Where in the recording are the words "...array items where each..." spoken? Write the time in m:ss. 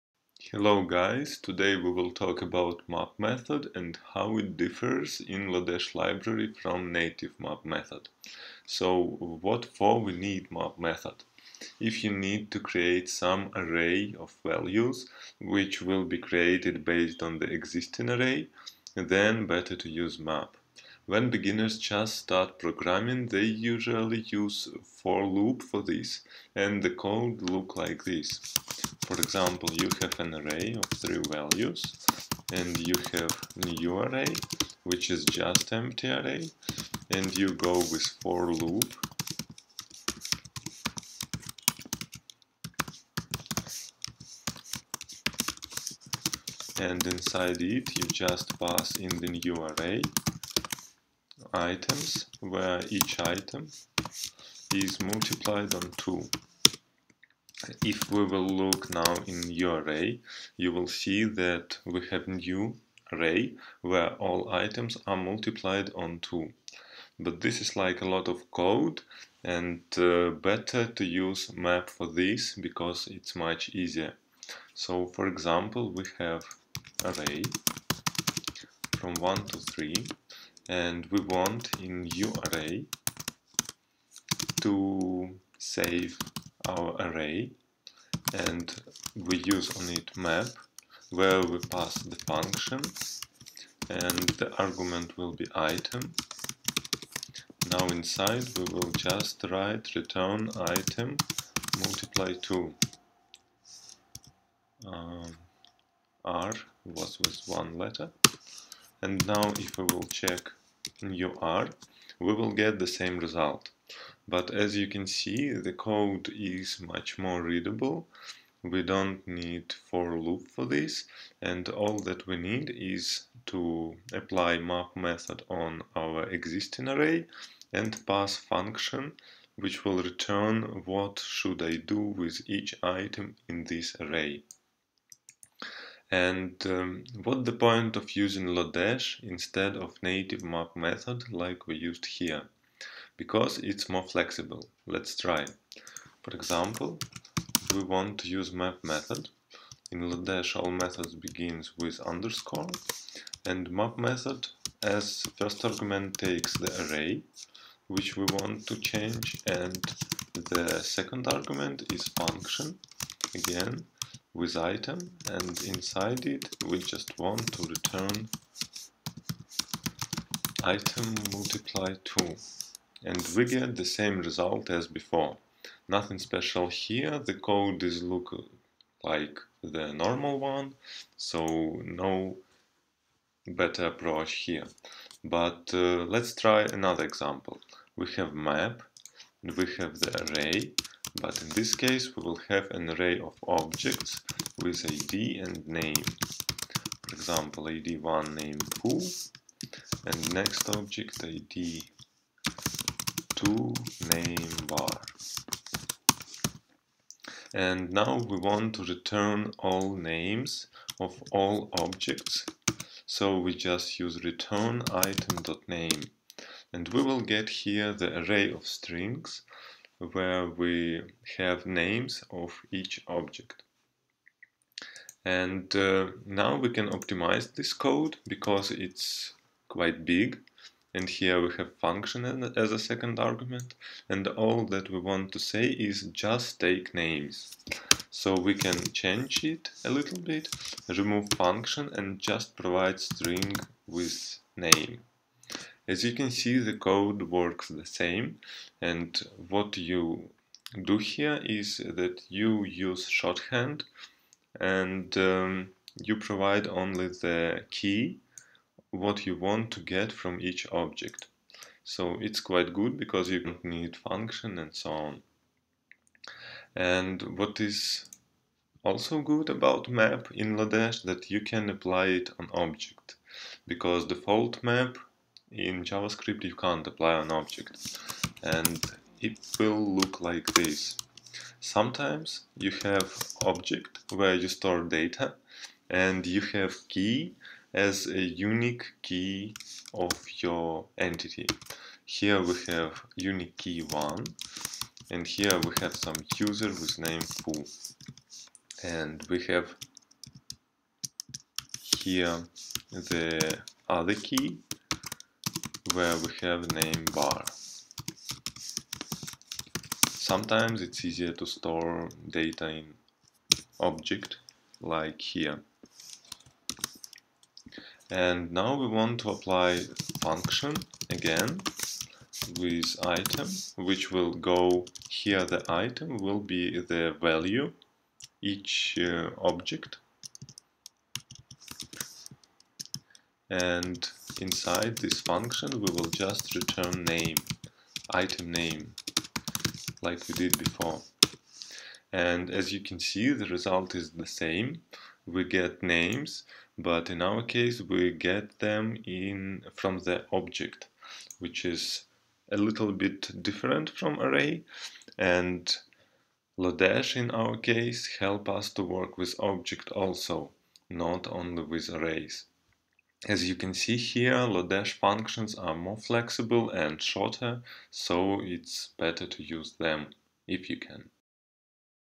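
0:49.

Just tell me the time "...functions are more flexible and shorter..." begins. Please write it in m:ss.
6:04.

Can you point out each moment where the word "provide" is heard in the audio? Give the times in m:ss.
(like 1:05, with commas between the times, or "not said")
4:02, 4:16.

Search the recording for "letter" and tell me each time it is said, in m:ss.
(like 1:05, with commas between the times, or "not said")
1:47.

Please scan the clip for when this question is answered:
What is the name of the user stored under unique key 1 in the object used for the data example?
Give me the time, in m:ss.
4:56.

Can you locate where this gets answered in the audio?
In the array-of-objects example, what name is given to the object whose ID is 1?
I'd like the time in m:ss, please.
3:18.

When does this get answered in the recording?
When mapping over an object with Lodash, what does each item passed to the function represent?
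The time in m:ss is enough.
5:25.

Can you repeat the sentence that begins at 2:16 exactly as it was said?
And um, what the point of using Lodash instead of native map method like we used here?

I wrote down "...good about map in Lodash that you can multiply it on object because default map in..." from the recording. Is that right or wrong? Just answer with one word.
wrong.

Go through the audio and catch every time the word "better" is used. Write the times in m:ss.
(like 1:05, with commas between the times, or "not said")
0:19, 1:10, 3:03, 6:08.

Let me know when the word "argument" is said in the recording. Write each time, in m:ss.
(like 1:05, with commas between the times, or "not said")
1:34, 2:35, 2:41, 3:53.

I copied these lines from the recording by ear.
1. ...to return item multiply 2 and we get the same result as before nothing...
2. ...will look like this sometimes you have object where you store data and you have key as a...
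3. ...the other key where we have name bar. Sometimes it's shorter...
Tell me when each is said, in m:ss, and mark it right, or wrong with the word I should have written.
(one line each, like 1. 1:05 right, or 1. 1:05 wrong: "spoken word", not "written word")
1. 2:47 right
2. 4:39 right
3. 5:02 wrong: "easier", not "shorter".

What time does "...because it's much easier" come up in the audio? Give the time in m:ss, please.
1:12.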